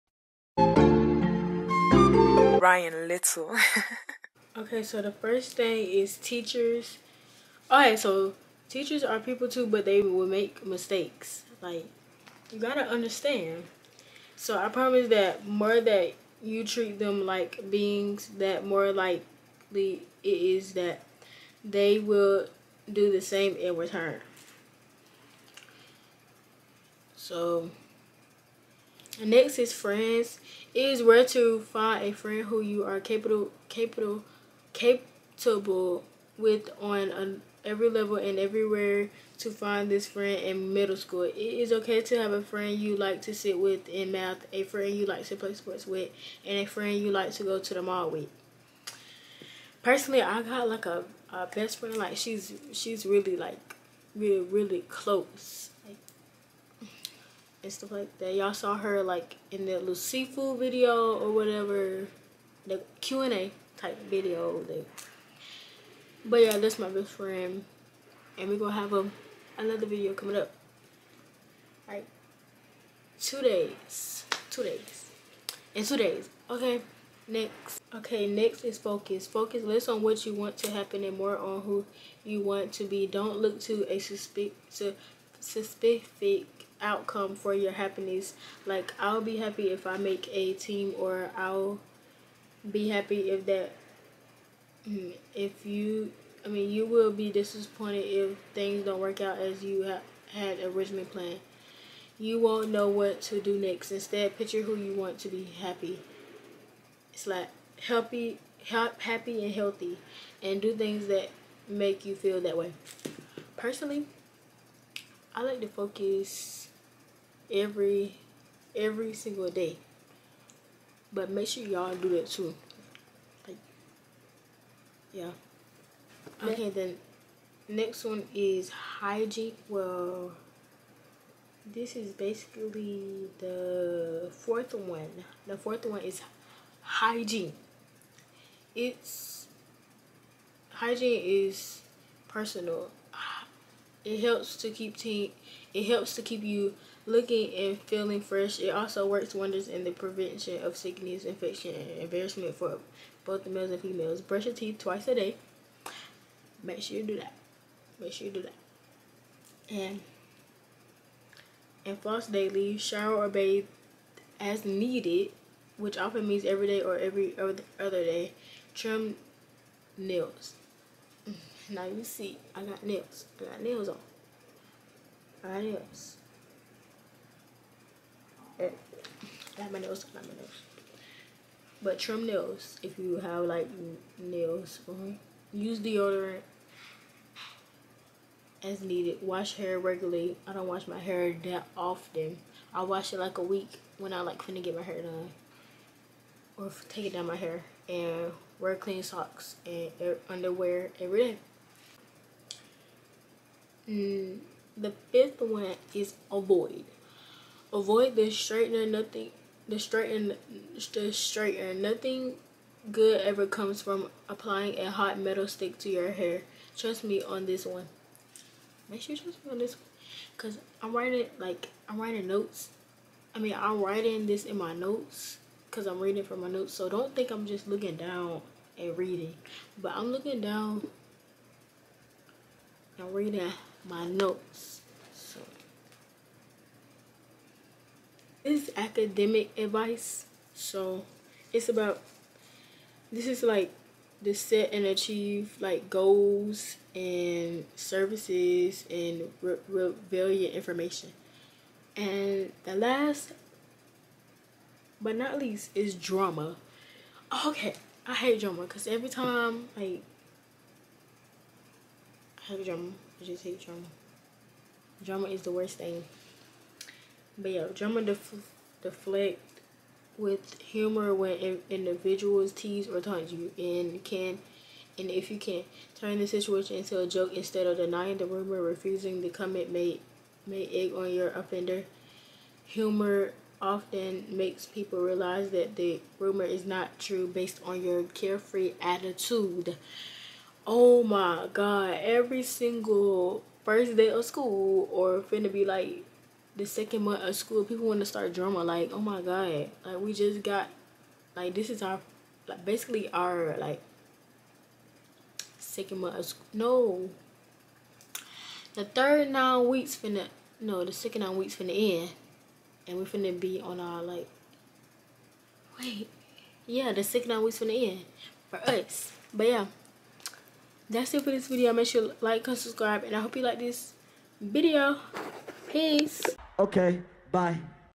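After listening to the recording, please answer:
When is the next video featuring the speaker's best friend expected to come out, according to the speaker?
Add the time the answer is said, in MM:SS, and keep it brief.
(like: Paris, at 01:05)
In 2 days, at 01:15.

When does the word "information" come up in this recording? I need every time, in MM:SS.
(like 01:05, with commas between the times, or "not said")
04:10.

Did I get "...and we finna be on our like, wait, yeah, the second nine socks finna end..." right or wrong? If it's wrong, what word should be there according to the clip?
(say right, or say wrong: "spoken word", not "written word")
wrong: "weeks", not "socks".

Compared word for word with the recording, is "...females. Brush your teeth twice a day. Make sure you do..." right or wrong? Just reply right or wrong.
right.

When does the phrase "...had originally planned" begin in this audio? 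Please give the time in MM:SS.
01:40.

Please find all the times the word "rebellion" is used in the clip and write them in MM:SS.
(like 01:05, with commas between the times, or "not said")
04:09.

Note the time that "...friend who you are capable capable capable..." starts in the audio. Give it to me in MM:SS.
00:32.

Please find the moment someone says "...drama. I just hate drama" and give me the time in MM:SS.
04:22.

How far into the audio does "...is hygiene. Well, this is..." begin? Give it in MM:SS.
02:08.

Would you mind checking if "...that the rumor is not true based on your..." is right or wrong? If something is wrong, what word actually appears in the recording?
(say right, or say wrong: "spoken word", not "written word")
right.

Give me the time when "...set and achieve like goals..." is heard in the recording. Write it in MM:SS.
04:04.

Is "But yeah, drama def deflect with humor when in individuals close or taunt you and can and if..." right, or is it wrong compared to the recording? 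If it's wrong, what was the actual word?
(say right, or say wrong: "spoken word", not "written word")
wrong: "tease", not "close".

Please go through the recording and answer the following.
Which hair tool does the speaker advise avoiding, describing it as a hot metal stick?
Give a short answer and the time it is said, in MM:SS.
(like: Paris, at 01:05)
The straightener, at 03:28.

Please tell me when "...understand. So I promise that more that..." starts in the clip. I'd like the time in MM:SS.
00:12.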